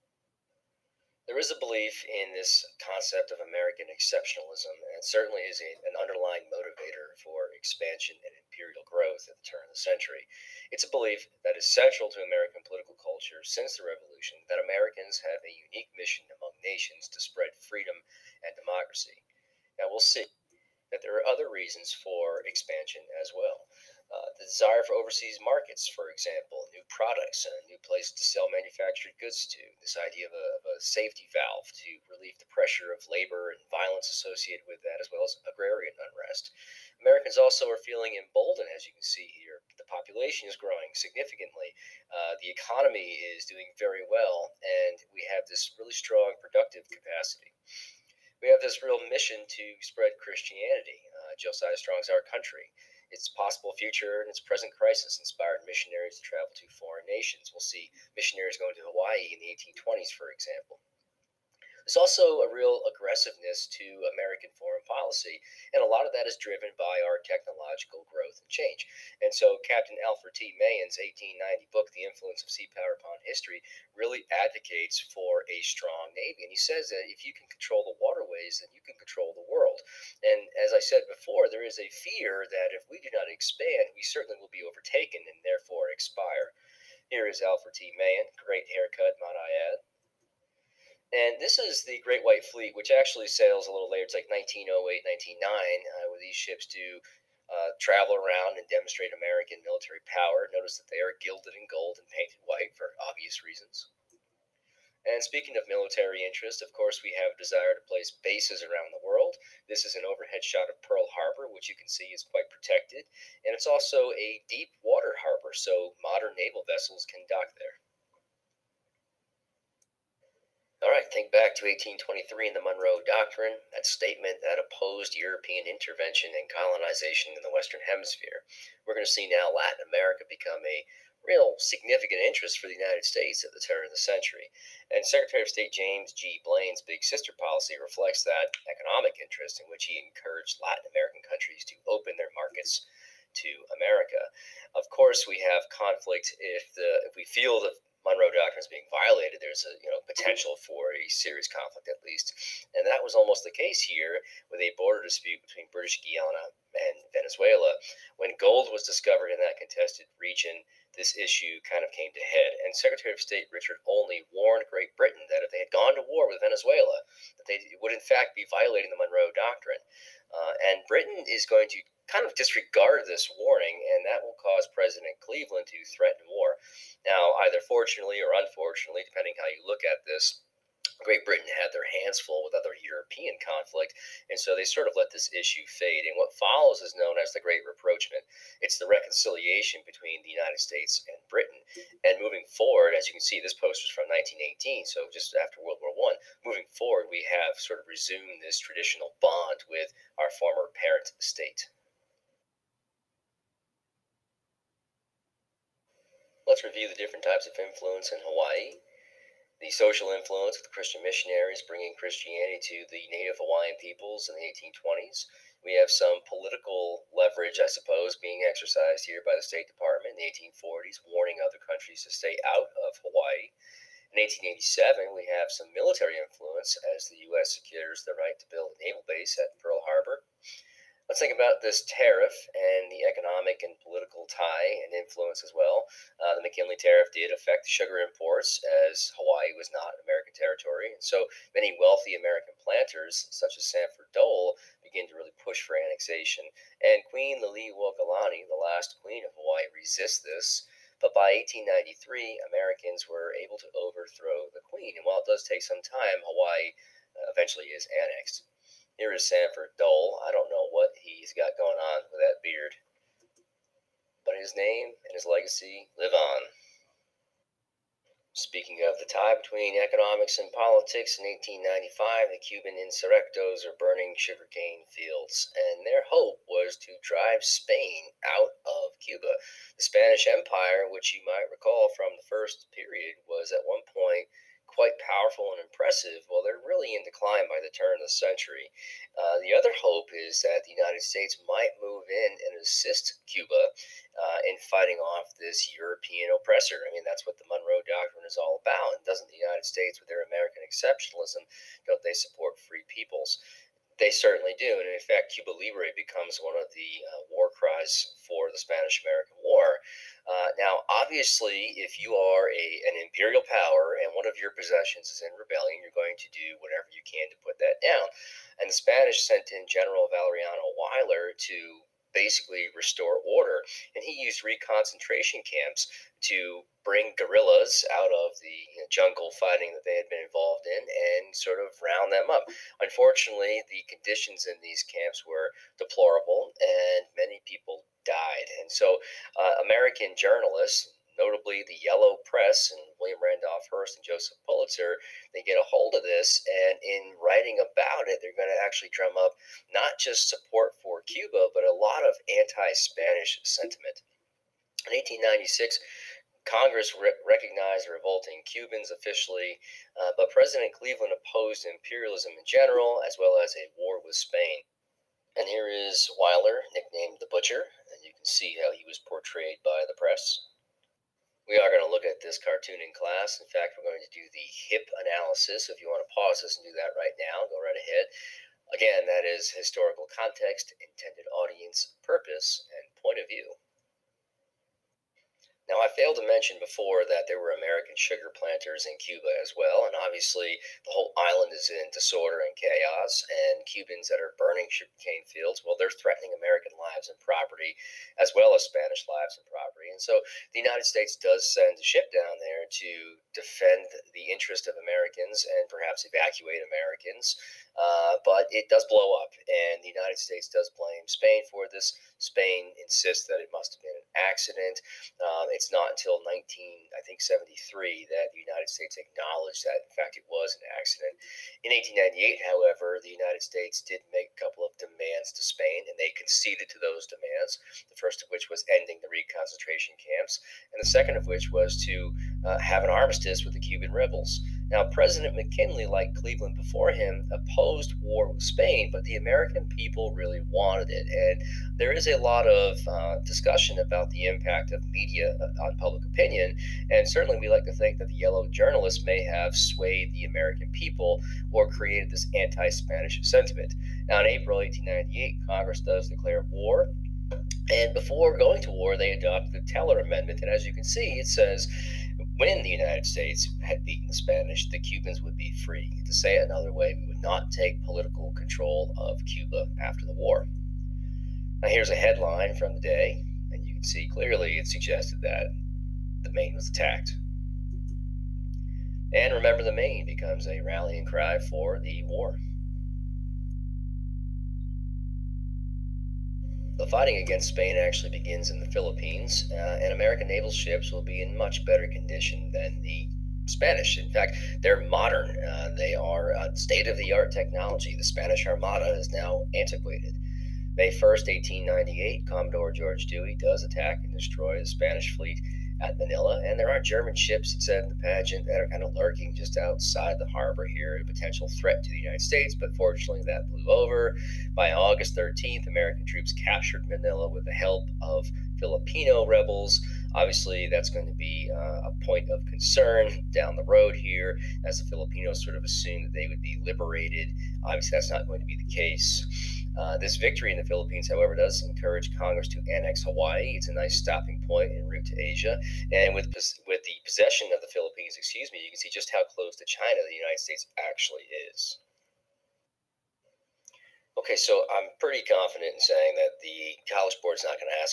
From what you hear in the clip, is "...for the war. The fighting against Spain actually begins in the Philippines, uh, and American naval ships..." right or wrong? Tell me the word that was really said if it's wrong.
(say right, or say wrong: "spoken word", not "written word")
right.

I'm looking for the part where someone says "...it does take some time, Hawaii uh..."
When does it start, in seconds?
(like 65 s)
255 s.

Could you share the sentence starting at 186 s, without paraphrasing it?
And what follows is known as the Great Rapprochement.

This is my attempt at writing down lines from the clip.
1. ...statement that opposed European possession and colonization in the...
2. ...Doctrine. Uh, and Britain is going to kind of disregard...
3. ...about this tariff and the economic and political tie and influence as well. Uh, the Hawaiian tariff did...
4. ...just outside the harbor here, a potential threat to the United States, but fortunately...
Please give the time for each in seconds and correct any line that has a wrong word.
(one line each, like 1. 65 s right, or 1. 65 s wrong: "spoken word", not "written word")
1. 123 s wrong: "intervention", not "possession"
2. 169 s right
3. 231 s wrong: "McKinley", not "Hawaiian"
4. 509 s right.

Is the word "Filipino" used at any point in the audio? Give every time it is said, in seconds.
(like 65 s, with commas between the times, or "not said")
518 s, 524 s.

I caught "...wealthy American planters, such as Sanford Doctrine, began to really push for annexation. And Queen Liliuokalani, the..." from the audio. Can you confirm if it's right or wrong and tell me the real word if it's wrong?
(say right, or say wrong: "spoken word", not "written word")
wrong: "Dole", not "Doctrine".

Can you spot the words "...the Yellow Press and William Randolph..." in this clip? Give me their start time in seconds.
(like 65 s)
341 s.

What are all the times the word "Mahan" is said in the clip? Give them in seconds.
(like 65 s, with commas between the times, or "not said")
70 s, 87 s.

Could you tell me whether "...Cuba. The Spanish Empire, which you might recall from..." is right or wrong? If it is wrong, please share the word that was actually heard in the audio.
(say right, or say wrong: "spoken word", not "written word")
right.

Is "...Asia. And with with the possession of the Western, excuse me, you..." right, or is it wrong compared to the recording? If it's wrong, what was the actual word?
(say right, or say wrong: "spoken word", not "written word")
wrong: "Philippines", not "Western".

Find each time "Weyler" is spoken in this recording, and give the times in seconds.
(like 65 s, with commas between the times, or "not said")
320 s, 366 s.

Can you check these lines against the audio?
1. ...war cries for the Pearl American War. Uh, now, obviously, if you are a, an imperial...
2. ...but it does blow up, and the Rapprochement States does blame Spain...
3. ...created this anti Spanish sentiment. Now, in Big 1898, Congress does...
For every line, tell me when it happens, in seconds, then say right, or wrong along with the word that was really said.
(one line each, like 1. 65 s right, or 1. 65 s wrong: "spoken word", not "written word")
1. 307 s wrong: "Spanish", not "Pearl"
2. 408 s wrong: "United", not "Rapprochement"
3. 451 s wrong: "April", not "Big".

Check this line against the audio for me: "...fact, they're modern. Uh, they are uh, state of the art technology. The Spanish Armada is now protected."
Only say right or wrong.
wrong.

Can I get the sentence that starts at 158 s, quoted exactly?
When gold was discovered in that contested region, this issue kind of came to head.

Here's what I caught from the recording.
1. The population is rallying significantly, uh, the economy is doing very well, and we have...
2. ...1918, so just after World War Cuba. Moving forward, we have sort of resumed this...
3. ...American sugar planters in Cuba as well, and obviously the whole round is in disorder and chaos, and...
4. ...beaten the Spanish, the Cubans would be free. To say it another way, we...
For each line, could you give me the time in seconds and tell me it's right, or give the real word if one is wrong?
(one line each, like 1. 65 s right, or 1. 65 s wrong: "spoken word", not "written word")
1. 39 s wrong: "growing", not "rallying"
2. 194 s wrong: "One", not "Cuba"
3. 387 s wrong: "island", not "round"
4. 463 s right.